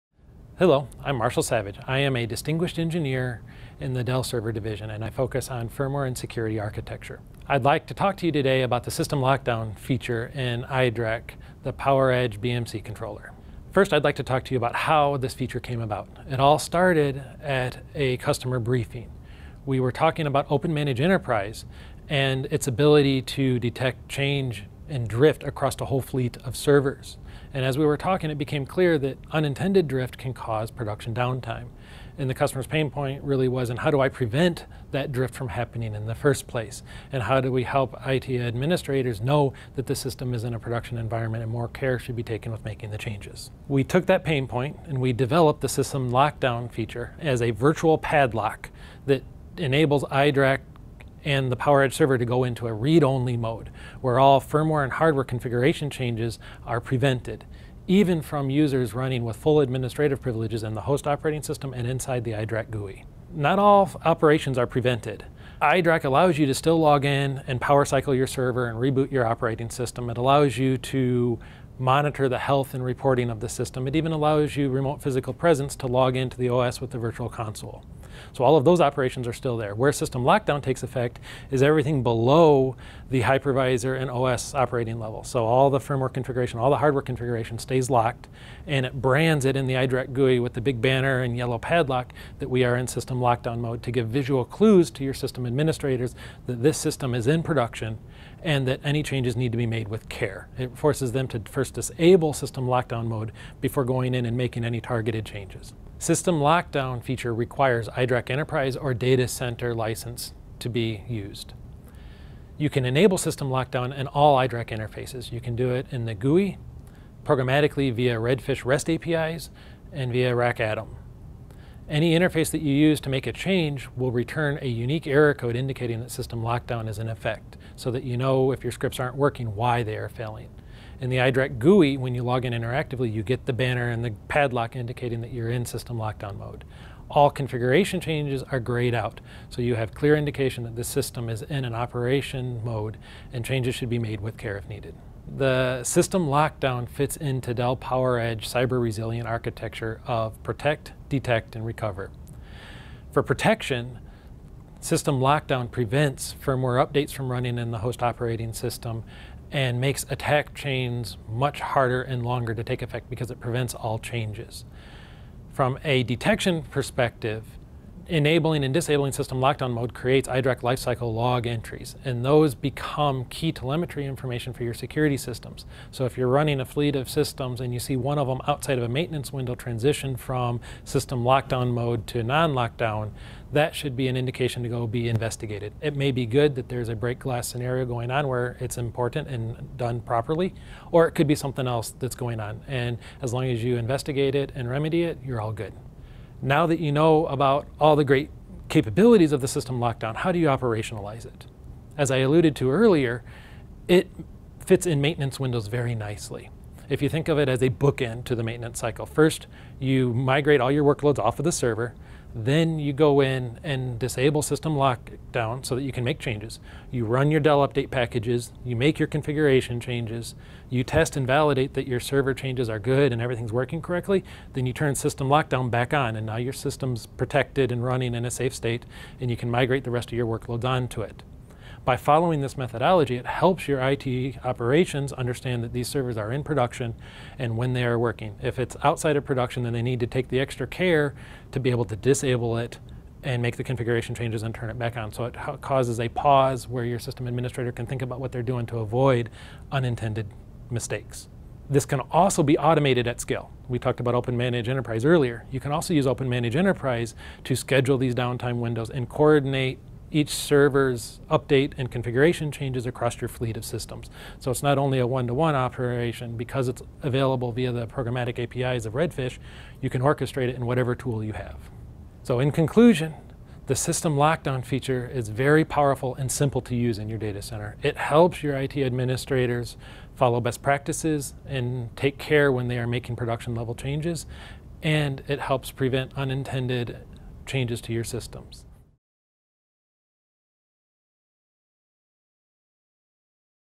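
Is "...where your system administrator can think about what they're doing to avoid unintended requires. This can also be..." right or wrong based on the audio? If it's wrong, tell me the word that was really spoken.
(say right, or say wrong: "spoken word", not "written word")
wrong: "mistakes", not "requires".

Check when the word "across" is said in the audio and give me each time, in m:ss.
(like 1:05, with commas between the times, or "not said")
0:25, 4:22.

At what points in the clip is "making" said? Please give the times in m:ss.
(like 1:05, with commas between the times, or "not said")
0:42, 1:44, 4:42.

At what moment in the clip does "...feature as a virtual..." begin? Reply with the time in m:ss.
0:46.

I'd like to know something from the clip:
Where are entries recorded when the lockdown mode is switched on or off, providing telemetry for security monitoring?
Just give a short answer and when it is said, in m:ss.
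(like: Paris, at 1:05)
iDRAC lifecycle log, at 2:50.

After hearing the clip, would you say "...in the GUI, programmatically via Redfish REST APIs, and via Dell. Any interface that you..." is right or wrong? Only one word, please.
wrong.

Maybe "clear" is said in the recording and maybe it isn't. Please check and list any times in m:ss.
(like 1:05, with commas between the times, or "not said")
0:28, 2:19.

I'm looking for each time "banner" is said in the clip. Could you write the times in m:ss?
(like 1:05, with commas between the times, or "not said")
1:30, 2:13.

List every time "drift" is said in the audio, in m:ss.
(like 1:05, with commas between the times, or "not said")
0:25, 0:29, 0:35.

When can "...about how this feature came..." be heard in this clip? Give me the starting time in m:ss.
0:14.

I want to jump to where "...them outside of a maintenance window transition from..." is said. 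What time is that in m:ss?
2:58.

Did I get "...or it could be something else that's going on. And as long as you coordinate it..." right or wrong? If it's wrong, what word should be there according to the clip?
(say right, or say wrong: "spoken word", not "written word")
wrong: "investigate", not "coordinate".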